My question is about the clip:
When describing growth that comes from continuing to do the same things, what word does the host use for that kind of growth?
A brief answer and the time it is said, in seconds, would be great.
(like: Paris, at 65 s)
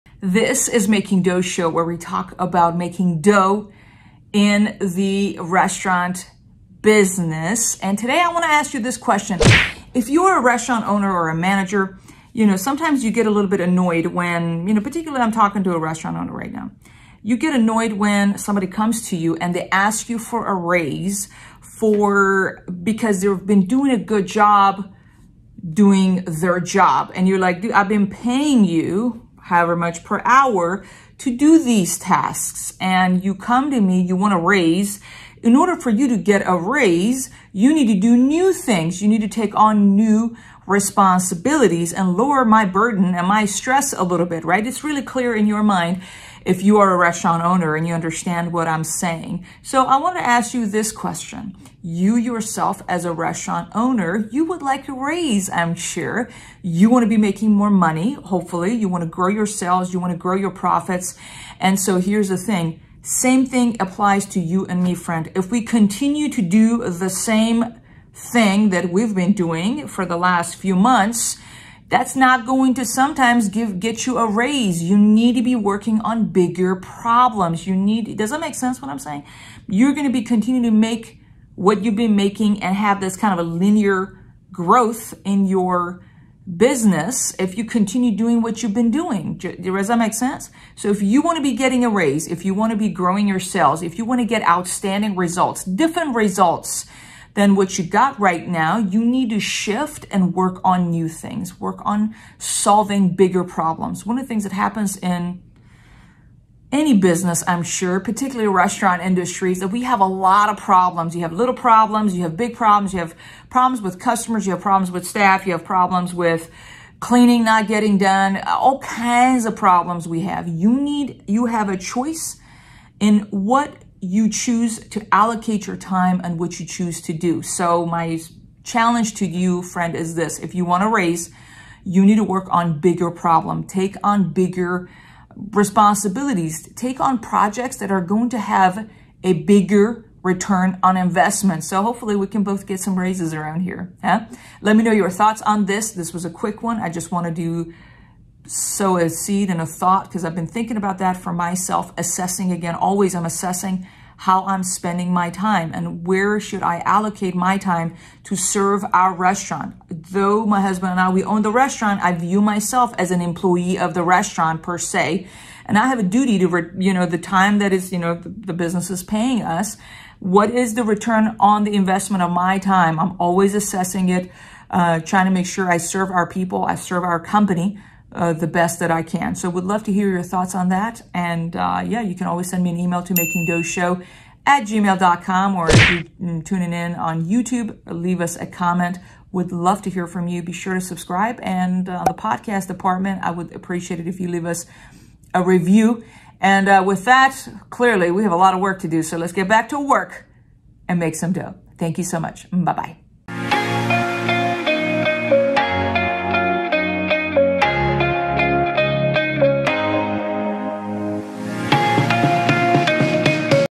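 linear, at 83 s.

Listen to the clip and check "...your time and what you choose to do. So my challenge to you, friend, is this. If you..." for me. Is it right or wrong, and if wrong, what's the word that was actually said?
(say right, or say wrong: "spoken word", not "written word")
right.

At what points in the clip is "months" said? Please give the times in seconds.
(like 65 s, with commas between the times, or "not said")
70 s.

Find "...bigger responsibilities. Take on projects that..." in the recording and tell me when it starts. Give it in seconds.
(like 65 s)
134 s.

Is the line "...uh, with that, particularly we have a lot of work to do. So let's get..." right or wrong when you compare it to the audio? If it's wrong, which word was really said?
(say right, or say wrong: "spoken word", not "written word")
wrong: "clearly", not "particularly".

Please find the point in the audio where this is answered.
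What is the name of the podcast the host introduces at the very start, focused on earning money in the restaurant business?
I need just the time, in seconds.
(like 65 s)
0 s.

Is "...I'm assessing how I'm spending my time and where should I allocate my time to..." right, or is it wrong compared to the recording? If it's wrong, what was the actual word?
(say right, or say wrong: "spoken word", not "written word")
right.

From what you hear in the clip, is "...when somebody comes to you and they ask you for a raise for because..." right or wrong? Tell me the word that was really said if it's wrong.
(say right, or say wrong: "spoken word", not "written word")
right.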